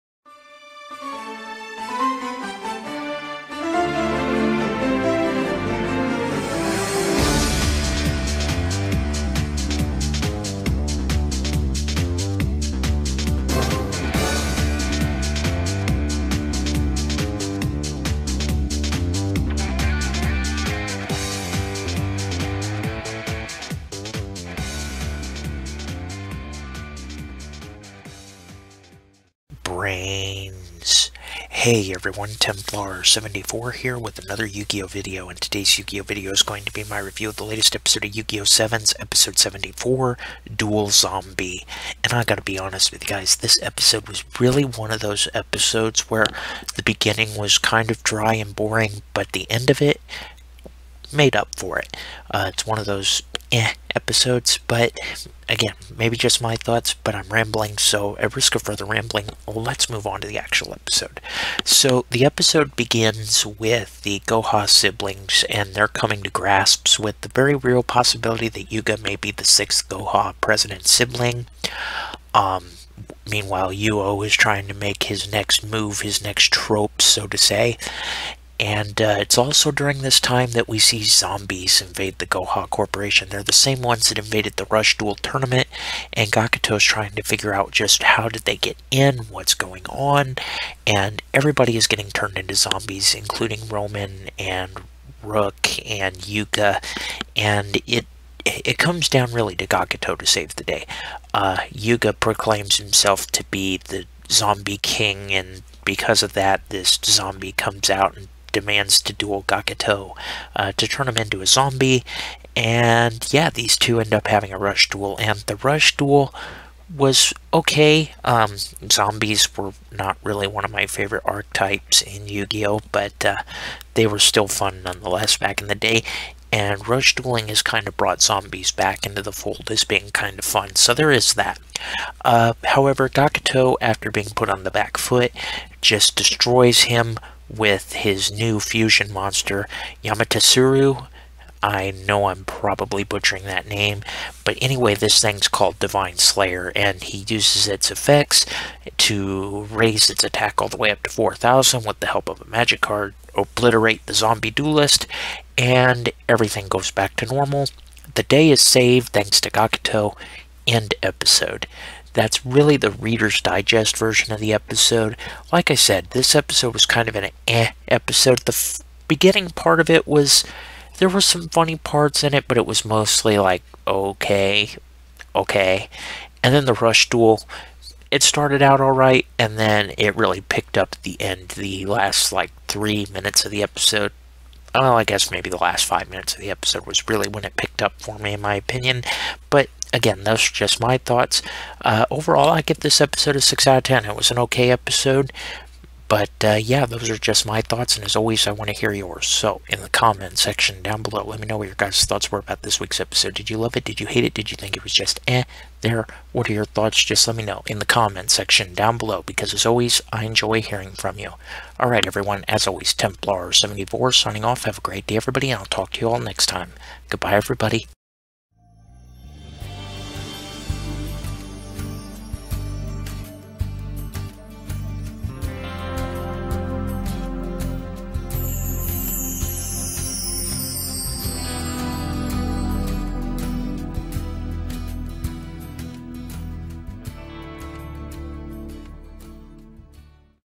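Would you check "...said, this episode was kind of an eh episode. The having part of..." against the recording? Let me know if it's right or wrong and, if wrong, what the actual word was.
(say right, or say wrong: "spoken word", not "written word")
wrong: "beginning", not "having".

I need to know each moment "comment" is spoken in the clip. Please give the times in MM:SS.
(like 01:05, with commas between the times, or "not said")
03:19, 03:27.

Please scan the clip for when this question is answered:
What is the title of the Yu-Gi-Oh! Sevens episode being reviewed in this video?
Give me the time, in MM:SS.
00:40.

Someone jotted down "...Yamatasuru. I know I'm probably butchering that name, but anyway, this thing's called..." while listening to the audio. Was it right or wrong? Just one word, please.
right.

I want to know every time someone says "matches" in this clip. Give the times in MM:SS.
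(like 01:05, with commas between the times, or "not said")
not said.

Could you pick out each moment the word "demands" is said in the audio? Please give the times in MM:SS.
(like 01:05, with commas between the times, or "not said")
01:48.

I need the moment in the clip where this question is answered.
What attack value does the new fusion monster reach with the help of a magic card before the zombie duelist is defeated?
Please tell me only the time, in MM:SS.
02:31.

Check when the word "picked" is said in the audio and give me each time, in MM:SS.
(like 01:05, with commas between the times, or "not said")
03:00, 03:07.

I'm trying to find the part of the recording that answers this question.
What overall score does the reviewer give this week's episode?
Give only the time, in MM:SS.
03:13.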